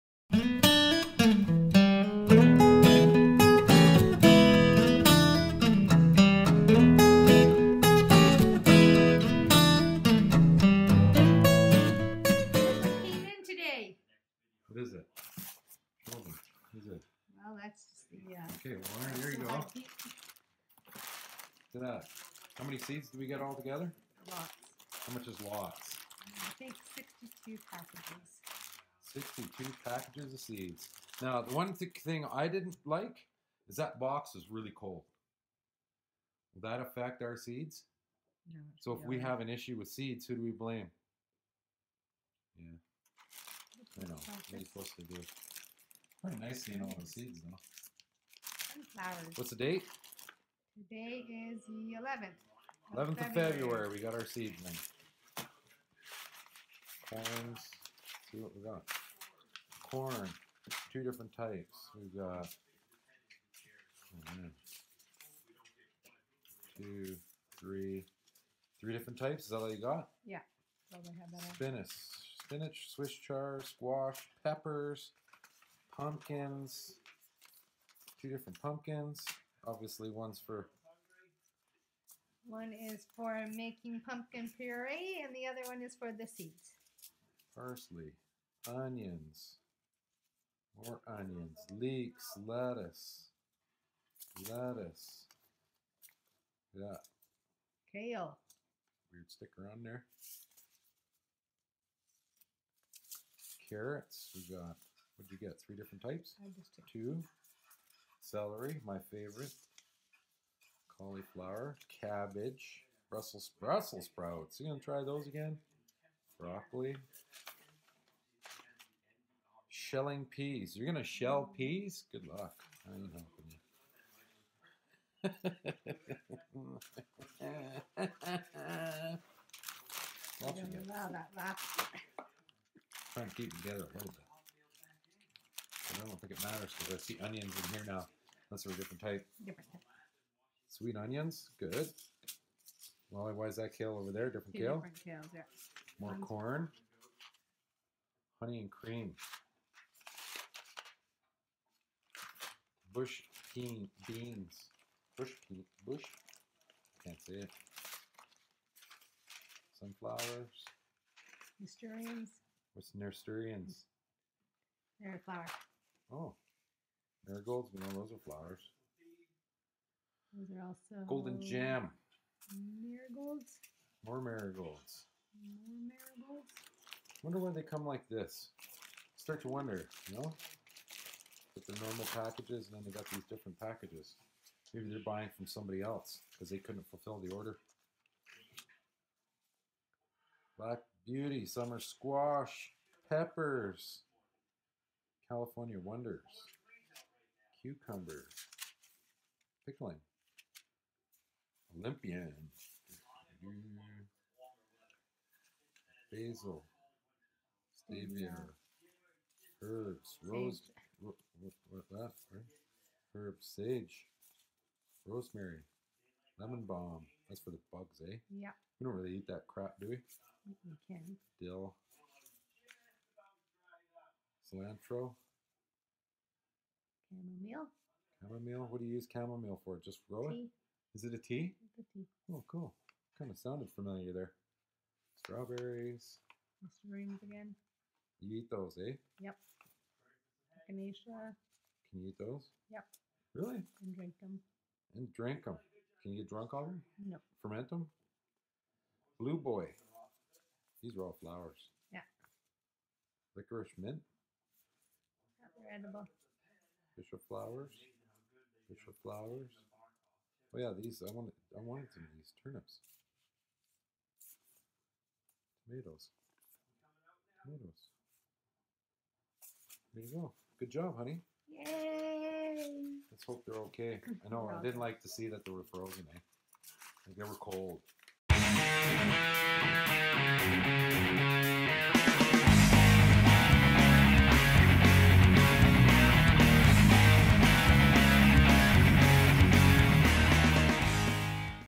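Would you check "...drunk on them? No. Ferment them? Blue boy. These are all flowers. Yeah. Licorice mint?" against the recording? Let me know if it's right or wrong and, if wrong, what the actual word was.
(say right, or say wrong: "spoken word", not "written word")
right.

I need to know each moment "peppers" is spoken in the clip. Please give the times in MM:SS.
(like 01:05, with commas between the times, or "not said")
01:14, 03:13.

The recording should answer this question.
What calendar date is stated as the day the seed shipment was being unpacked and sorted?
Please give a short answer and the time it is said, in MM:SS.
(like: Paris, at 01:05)
11th of February, at 00:52.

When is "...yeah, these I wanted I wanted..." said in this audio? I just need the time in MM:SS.
04:20.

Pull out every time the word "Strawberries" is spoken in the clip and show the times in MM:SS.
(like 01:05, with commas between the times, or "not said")
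03:55.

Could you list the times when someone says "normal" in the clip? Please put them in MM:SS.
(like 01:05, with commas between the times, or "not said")
03:01.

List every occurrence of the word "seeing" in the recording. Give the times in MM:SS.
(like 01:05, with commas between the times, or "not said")
00:46.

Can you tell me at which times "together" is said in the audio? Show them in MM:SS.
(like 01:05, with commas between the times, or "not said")
00:23, 02:13.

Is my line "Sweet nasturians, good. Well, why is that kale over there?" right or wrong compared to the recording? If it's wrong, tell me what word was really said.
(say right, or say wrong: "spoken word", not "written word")
wrong: "onions", not "nasturians".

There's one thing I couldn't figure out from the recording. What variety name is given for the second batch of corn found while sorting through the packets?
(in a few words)
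Honey and cream.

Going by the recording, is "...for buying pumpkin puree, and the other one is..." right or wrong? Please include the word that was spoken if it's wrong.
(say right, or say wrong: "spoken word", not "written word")
wrong: "making", not "buying".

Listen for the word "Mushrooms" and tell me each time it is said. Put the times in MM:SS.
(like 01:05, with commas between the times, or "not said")
03:56.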